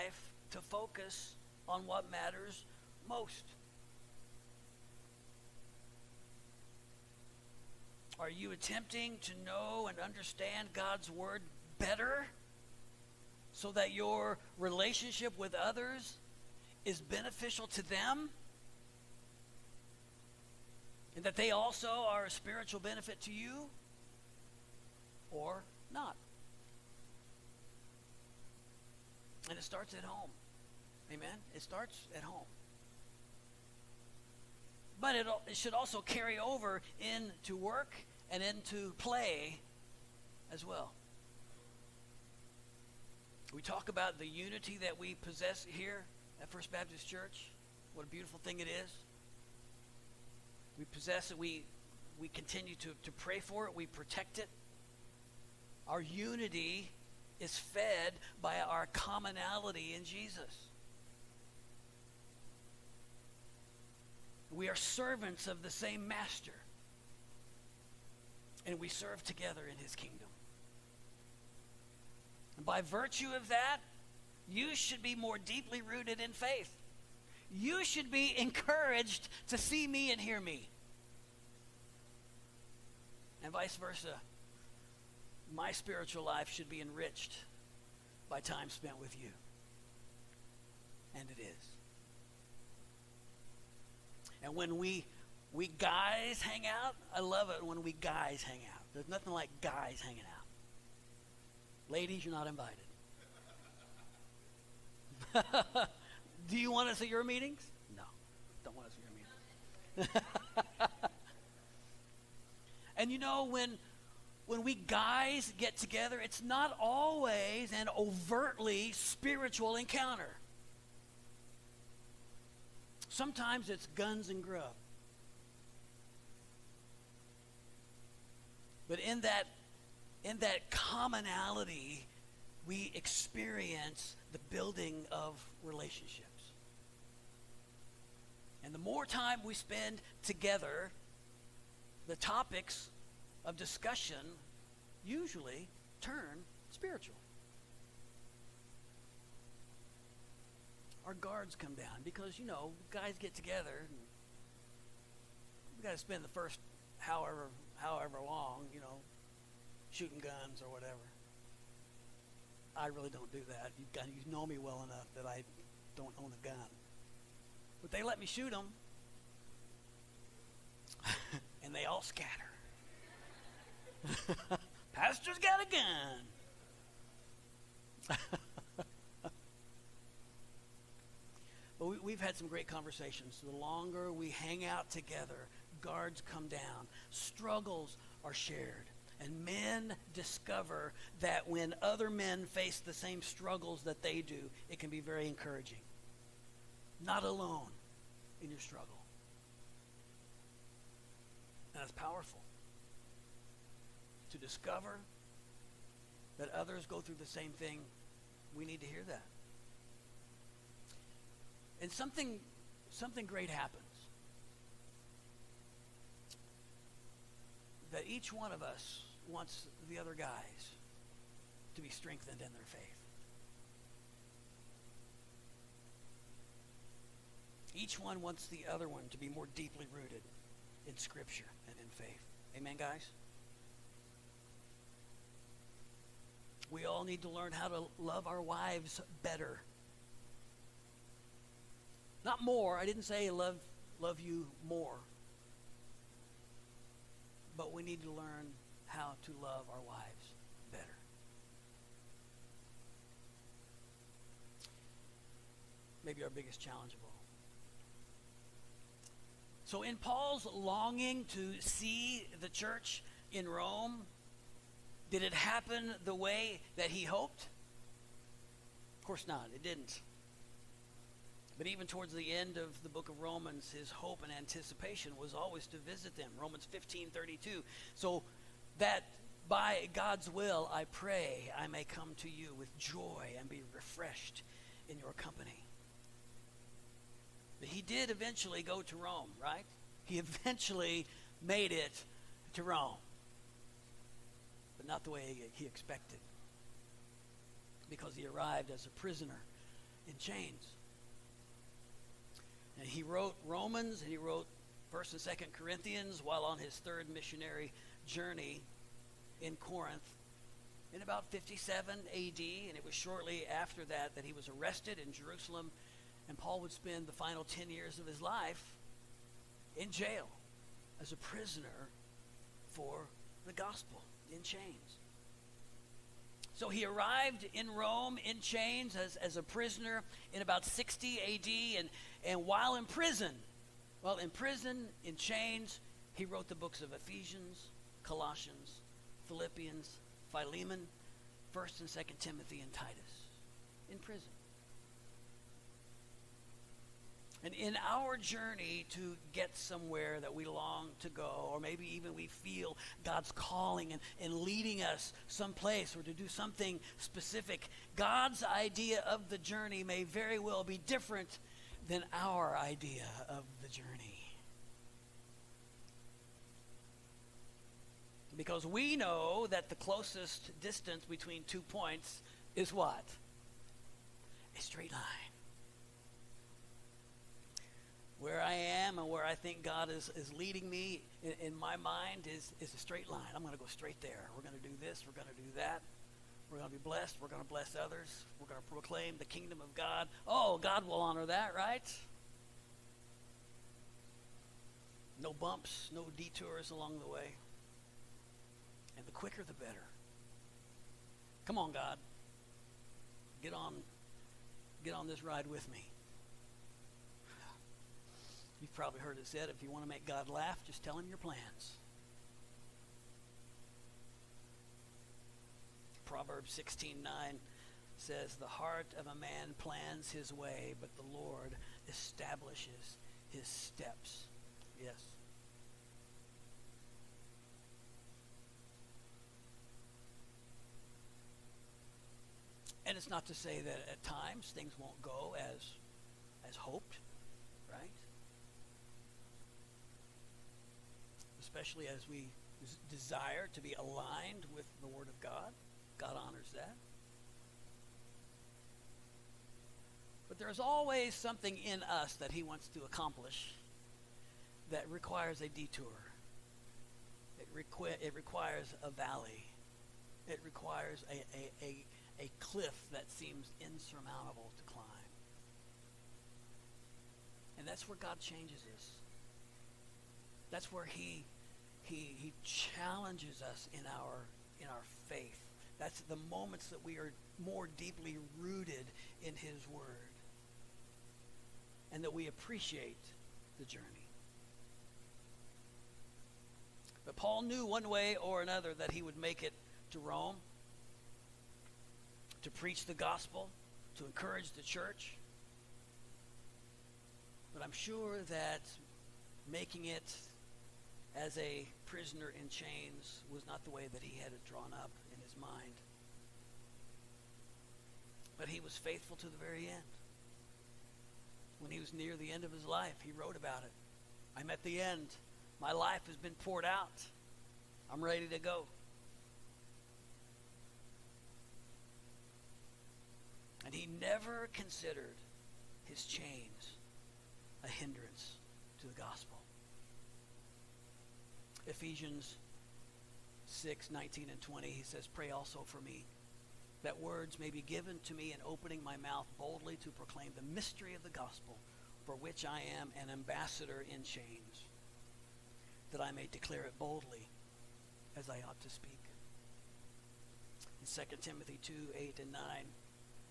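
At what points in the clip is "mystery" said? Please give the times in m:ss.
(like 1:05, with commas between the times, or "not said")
9:00.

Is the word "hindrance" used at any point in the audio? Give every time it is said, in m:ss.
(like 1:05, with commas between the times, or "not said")
8:47.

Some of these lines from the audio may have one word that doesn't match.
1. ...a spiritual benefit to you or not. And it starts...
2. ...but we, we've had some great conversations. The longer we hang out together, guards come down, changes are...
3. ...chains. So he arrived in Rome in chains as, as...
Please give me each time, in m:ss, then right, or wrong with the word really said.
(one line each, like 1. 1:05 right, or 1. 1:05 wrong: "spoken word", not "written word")
1. 0:22 right
2. 3:01 wrong: "struggles", not "changes"
3. 5:24 right.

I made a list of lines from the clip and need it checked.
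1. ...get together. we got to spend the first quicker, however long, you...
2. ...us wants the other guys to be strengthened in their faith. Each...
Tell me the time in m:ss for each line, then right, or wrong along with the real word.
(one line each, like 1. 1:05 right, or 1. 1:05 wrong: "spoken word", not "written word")
1. 2:33 wrong: "however", not "quicker"
2. 3:38 right.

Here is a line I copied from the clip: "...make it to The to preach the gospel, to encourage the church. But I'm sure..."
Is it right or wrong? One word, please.
wrong.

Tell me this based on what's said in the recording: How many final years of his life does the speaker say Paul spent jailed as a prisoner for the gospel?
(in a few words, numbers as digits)
10.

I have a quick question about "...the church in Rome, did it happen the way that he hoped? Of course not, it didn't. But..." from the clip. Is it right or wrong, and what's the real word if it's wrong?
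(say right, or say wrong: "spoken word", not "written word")
right.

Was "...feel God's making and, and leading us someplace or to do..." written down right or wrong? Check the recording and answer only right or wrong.
wrong.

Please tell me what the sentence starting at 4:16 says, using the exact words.
Maybe our biggest challenge of all.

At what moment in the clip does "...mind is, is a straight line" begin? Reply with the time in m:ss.
6:21.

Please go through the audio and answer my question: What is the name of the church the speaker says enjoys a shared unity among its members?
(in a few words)
First Baptist Church.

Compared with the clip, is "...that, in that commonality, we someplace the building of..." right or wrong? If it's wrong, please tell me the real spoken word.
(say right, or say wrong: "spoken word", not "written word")
wrong: "experience", not "someplace".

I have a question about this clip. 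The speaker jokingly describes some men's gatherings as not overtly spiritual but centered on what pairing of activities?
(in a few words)
Guns and grub.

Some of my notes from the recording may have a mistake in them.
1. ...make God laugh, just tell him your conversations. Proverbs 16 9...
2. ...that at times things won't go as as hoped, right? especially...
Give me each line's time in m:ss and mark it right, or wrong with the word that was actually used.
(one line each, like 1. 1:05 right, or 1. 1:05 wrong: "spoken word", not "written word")
1. 6:49 wrong: "plans", not "conversations"
2. 7:13 right.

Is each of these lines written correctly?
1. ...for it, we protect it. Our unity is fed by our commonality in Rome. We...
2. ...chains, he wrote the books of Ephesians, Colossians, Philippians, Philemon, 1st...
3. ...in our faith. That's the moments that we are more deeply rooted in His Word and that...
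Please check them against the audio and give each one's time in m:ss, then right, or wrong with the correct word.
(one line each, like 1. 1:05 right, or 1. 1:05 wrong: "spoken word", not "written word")
1. 0:53 wrong: "Jesus", not "Rome"
2. 5:35 right
3. 7:54 right.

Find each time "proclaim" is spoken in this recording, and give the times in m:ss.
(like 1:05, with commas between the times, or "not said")
6:28, 8:59.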